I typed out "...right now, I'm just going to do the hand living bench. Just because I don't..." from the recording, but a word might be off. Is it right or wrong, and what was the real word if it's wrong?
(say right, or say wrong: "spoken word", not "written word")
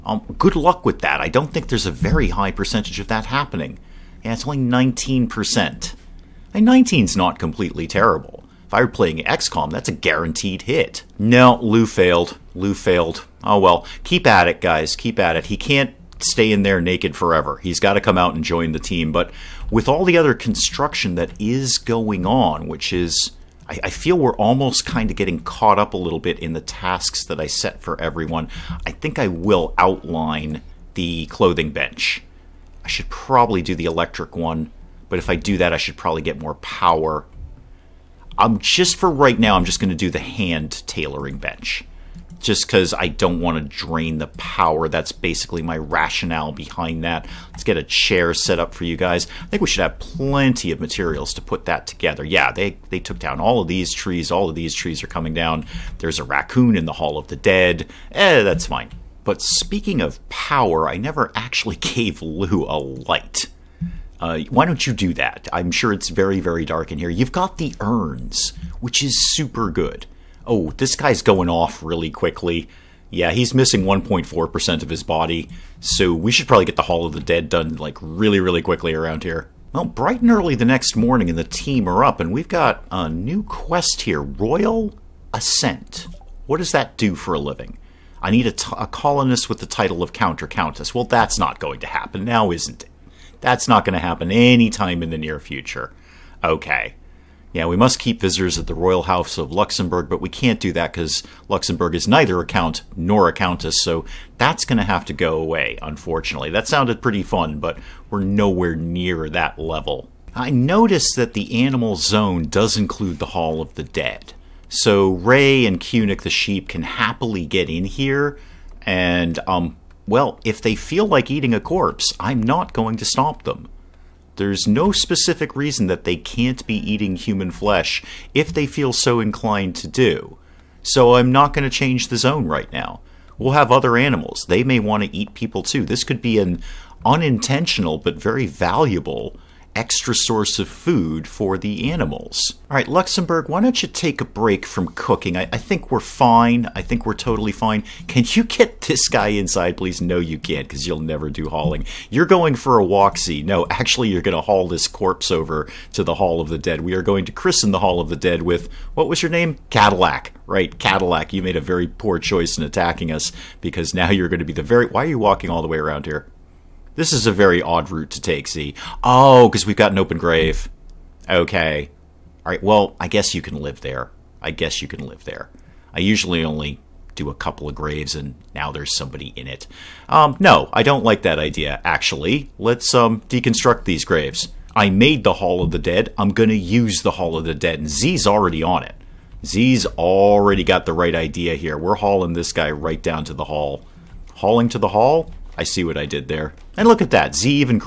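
wrong: "tailoring", not "living".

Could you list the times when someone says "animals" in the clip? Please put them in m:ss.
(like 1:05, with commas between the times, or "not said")
1:51, 2:13, 2:21.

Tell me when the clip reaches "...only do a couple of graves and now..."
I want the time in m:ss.
2:56.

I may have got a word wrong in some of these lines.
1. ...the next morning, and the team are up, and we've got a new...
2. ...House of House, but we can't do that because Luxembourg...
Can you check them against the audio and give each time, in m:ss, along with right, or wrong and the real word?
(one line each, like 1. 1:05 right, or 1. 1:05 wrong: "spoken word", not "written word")
1. 1:20 right
2. 1:39 wrong: "Luxembourg", not "House".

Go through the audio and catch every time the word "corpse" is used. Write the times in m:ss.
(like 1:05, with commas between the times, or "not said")
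2:01, 2:34.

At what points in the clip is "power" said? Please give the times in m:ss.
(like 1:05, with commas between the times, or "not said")
0:36, 0:44, 1:00.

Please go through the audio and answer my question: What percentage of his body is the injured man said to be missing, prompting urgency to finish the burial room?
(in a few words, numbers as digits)
1.4%.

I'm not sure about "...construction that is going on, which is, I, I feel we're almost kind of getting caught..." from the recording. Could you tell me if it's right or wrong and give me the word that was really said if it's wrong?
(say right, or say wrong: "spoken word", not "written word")
right.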